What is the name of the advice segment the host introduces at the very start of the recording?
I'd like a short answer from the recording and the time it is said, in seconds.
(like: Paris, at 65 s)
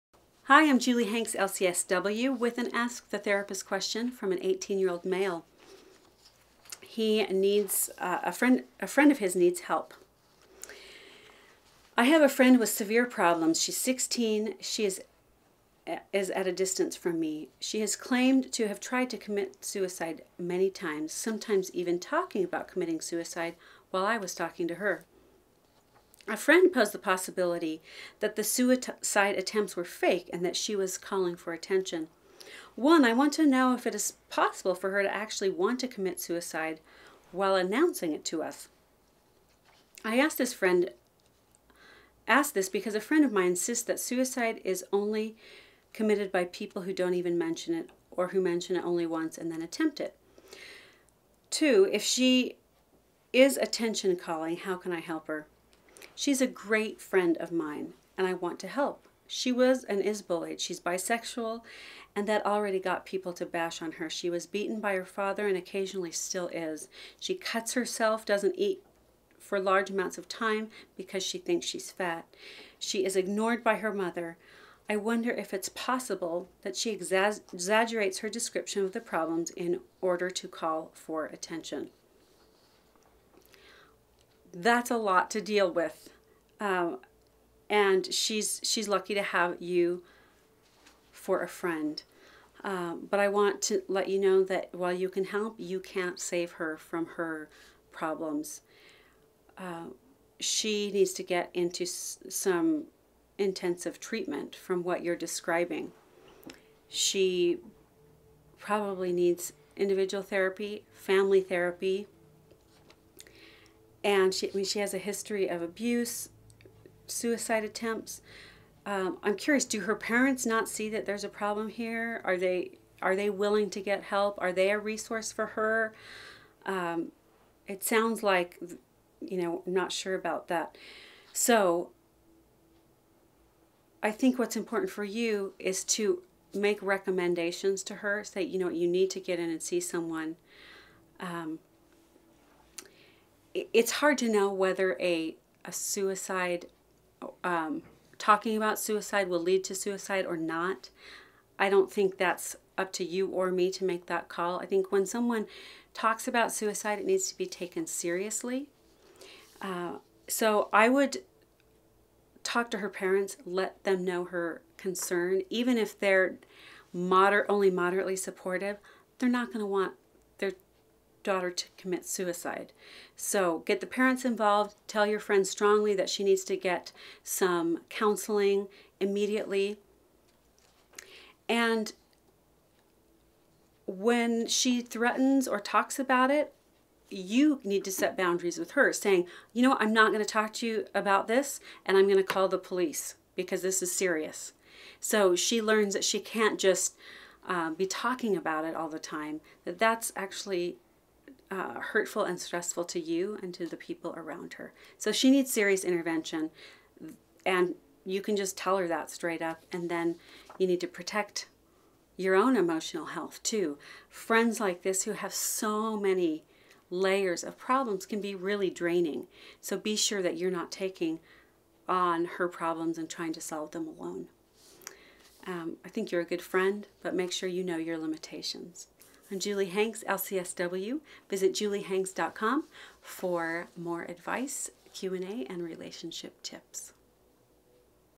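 Ask the Therapist, at 2 s.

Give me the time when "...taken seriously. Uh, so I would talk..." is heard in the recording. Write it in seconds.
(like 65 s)
157 s.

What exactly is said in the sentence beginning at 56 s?
She's a great friend of mine and I want to help.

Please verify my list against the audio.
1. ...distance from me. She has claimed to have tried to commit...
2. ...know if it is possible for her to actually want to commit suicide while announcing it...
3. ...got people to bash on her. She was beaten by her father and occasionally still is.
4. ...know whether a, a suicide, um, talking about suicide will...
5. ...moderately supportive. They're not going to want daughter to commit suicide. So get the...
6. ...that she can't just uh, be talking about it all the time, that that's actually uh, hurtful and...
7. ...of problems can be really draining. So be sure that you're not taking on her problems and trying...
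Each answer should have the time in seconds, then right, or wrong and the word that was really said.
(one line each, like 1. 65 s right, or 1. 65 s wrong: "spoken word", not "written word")
1. 16 s right
2. 33 s right
3. 62 s right
4. 144 s right
5. 167 s right
6. 195 s right
7. 217 s right.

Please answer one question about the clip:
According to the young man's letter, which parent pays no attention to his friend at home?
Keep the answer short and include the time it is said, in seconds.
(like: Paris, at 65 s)
Her mother, at 73 s.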